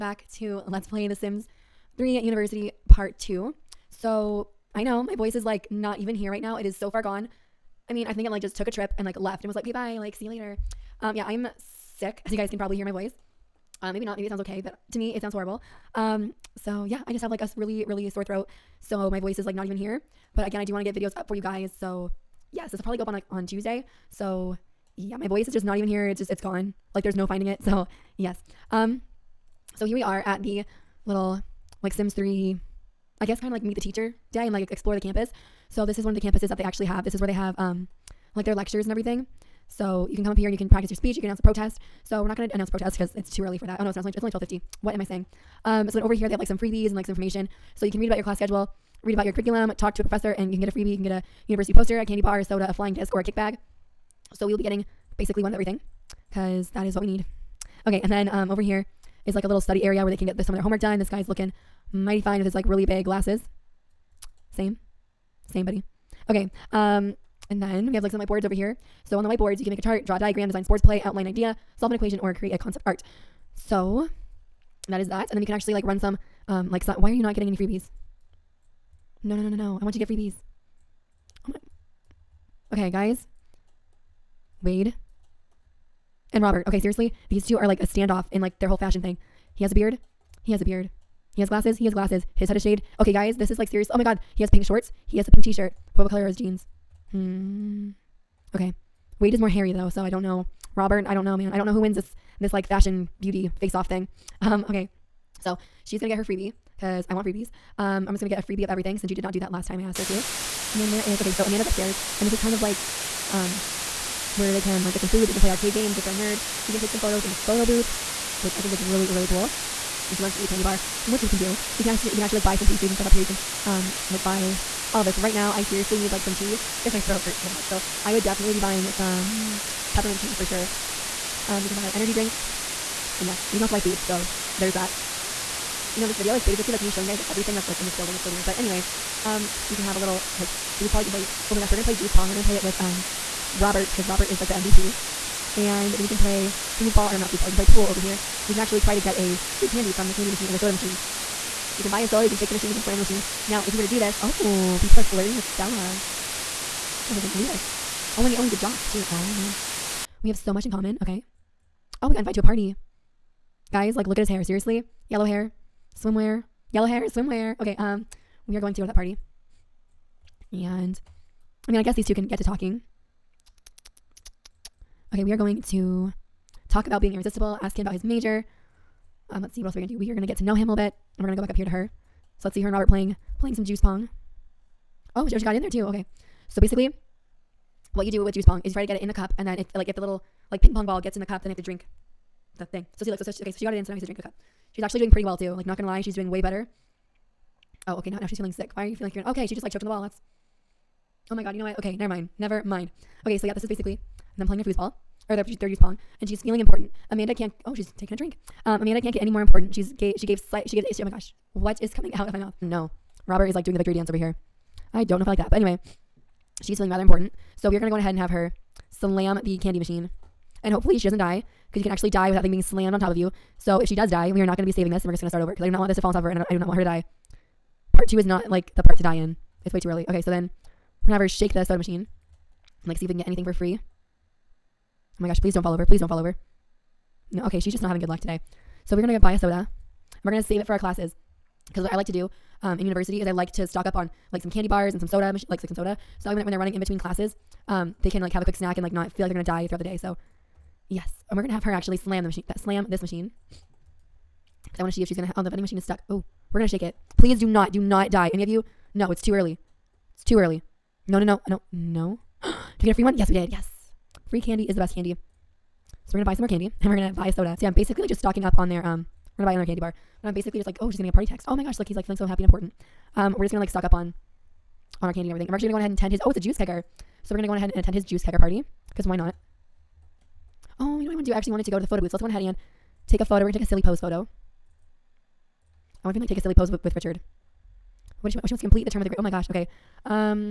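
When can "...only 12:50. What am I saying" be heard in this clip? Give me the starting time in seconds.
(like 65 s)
44 s.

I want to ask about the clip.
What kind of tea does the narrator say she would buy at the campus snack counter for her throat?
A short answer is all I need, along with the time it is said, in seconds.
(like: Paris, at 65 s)
Peppermint tea, at 129 s.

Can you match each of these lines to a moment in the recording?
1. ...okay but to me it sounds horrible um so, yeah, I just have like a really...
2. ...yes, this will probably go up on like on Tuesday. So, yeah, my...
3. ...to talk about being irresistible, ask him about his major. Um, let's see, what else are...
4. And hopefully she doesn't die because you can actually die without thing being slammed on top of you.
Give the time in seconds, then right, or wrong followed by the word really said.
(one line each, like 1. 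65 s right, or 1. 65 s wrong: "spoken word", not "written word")
1. 14 s right
2. 22 s right
3. 175 s right
4. 220 s right.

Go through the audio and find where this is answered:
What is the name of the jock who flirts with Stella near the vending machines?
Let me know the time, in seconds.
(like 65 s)
157 s.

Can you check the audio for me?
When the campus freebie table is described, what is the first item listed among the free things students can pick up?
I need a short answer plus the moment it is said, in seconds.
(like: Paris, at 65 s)
University poster, at 51 s.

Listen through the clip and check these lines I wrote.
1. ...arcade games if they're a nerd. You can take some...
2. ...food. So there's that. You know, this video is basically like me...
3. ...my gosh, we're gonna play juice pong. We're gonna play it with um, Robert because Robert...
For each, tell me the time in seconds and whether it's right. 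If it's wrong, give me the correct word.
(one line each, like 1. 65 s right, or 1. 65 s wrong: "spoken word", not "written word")
1. 115 s right
2. 133 s right
3. 141 s right.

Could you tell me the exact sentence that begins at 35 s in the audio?
So this is one of the campuses that they actually have.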